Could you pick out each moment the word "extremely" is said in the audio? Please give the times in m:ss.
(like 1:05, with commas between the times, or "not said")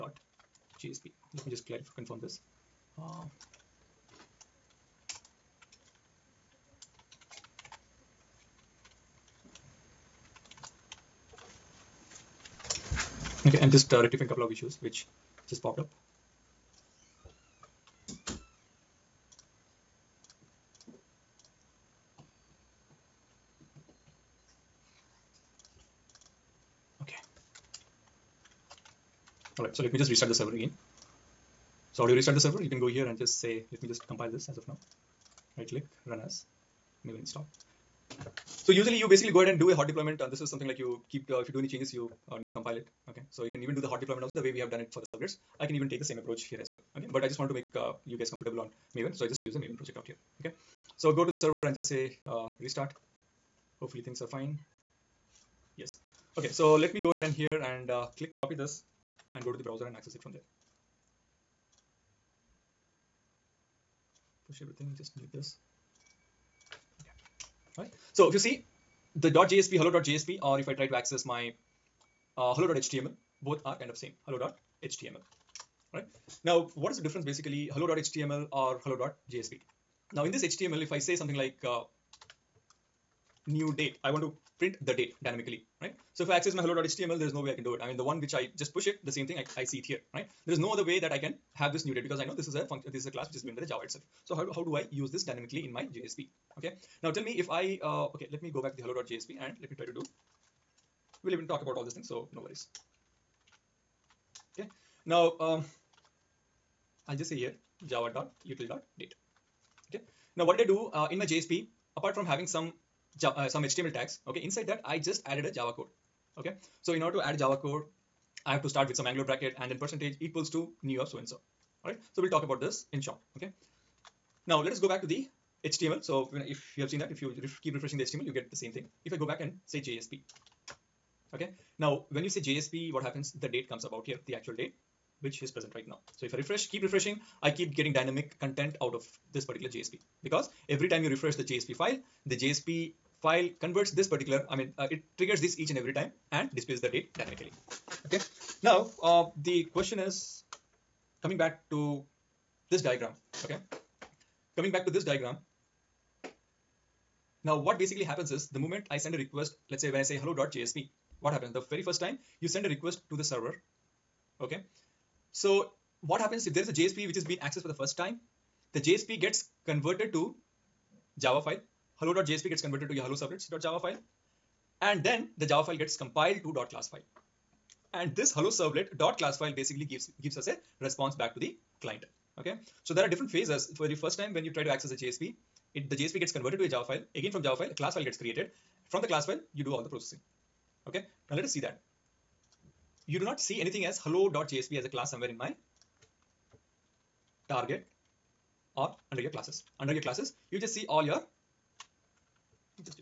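not said.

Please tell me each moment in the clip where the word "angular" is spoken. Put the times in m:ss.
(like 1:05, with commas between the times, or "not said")
1:59.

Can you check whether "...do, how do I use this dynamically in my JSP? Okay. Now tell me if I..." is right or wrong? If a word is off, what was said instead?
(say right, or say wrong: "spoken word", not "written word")
right.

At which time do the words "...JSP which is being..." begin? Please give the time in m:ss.
2:46.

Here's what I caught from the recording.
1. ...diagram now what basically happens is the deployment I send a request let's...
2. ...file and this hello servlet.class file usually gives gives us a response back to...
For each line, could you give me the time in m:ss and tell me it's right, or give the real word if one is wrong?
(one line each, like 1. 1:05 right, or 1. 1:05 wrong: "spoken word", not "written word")
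1. 2:35 wrong: "moment", not "deployment"
2. 2:56 wrong: "basically", not "usually".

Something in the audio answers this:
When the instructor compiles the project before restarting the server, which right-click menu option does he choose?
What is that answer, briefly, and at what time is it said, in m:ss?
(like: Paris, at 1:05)
Run as Maven install, at 0:36.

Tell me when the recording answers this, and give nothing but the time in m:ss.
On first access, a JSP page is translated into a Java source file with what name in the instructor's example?
2:53.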